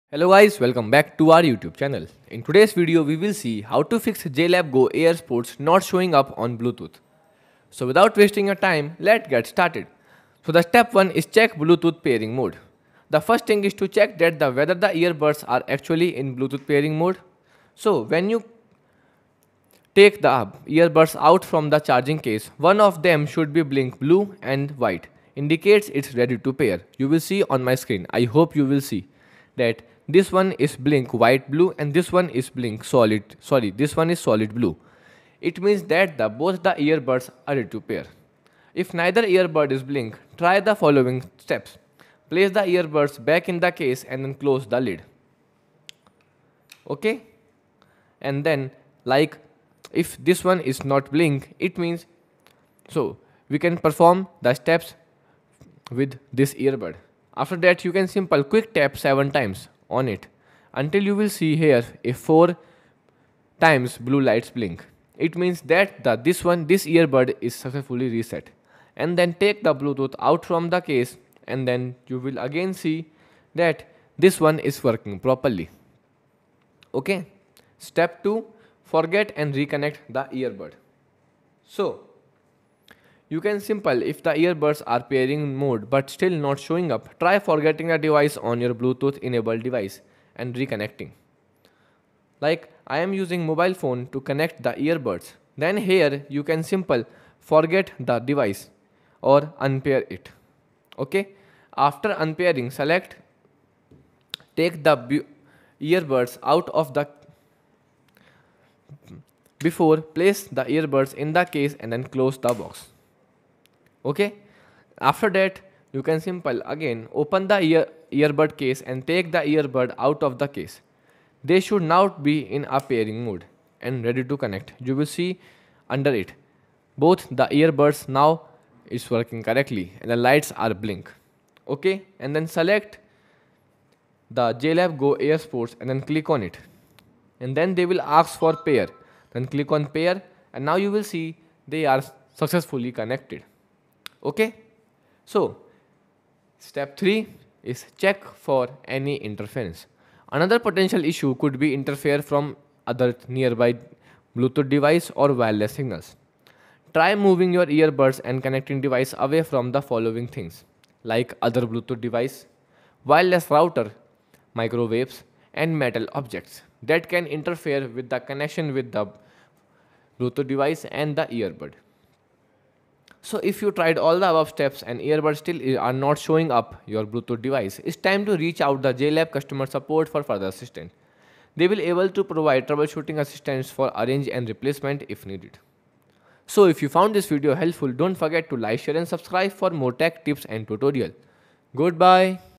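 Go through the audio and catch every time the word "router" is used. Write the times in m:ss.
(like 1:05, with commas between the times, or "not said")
2:43.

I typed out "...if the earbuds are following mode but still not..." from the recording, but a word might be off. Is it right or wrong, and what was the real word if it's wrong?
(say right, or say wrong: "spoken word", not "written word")
wrong: "pairing", not "following".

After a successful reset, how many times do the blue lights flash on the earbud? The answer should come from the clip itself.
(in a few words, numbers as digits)
4.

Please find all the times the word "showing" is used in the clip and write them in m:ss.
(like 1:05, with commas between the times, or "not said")
0:05, 1:26, 2:56.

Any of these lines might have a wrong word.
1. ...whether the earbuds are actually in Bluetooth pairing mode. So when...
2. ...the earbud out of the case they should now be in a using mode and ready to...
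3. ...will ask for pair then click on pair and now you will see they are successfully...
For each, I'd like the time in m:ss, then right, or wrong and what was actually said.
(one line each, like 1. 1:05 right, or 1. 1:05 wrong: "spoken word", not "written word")
1. 0:14 right
2. 1:59 wrong: "pairing", not "using"
3. 2:17 right.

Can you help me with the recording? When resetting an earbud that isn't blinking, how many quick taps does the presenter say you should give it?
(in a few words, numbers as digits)
7.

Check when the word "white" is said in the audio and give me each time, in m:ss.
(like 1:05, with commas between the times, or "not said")
0:24, 0:31.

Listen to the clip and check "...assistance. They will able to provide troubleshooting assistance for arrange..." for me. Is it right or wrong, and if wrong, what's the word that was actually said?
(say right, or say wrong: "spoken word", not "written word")
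right.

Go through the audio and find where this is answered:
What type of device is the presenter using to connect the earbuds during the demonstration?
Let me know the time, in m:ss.
1:33.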